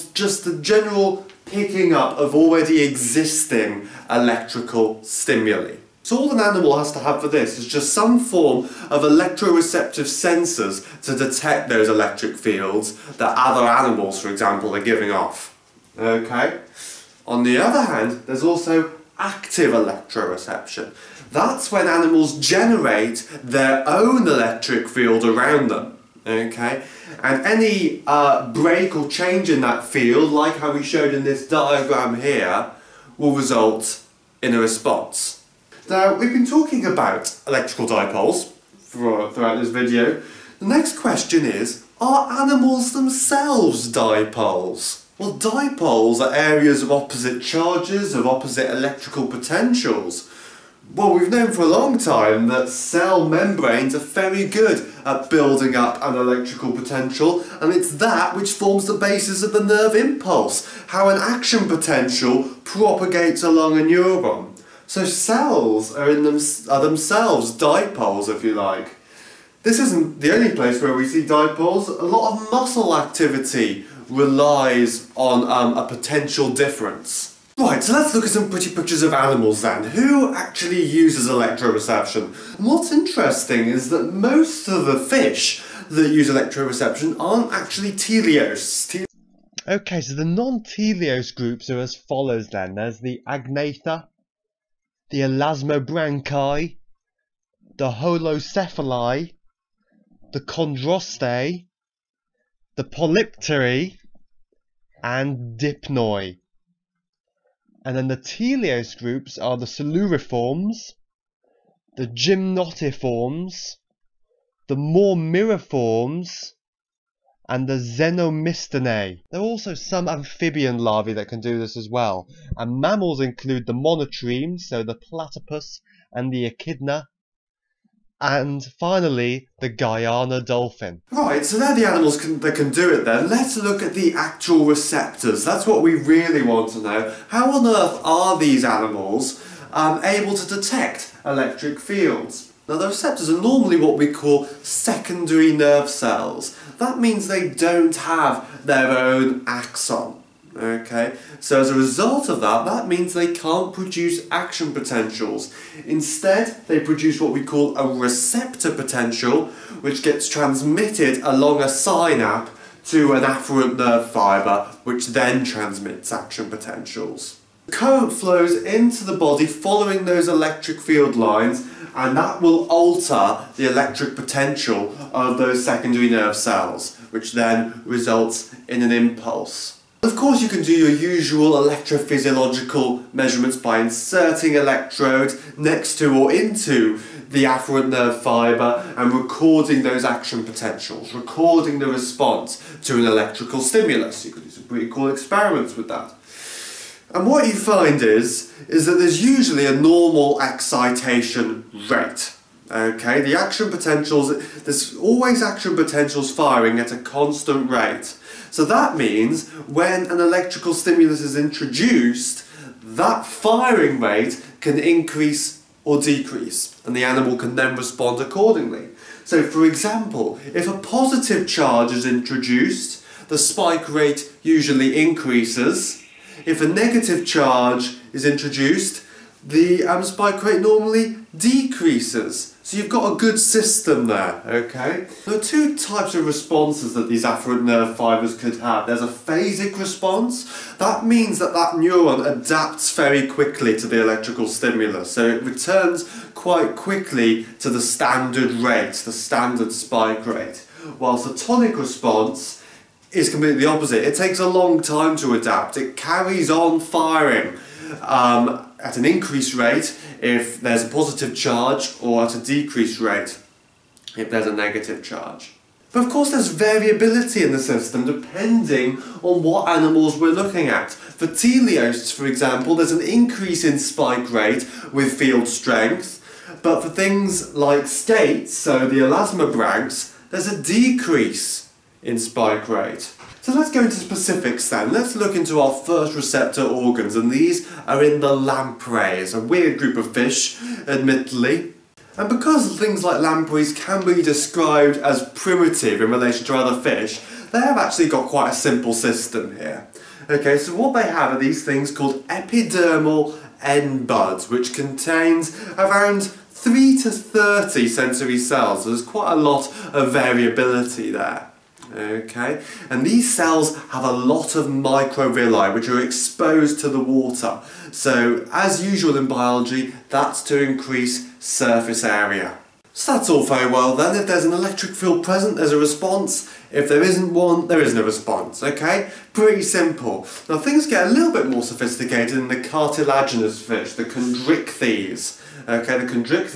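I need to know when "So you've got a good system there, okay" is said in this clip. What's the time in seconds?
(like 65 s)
232 s.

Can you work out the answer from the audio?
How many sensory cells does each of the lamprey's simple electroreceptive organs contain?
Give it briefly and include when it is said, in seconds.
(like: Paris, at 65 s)
3 to 30, at 306 s.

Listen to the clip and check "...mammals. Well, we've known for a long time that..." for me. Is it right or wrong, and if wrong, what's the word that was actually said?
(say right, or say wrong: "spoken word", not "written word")
wrong: "potentials", not "mammals".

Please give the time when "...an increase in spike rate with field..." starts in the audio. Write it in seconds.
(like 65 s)
272 s.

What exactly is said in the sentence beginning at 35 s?
Now, we've been talking about electrical dipoles for, throughout this video.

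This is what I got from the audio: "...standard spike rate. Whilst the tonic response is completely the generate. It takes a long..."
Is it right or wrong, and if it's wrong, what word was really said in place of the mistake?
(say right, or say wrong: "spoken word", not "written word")
wrong: "opposite", not "generate".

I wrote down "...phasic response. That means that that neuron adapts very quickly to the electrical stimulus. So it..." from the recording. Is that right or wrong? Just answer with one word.
right.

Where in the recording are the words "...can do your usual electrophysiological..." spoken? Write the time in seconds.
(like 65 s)
180 s.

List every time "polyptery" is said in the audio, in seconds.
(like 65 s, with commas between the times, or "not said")
102 s.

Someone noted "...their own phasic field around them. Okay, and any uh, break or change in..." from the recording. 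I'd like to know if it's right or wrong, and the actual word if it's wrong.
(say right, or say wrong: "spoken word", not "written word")
wrong: "electric", not "phasic".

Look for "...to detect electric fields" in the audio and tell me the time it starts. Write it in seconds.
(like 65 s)
140 s.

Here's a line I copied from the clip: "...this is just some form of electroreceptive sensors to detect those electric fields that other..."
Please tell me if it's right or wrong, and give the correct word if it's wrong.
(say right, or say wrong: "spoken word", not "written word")
right.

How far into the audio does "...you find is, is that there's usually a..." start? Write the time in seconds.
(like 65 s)
197 s.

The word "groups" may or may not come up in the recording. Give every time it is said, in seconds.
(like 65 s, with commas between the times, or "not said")
91 s, 108 s, 289 s.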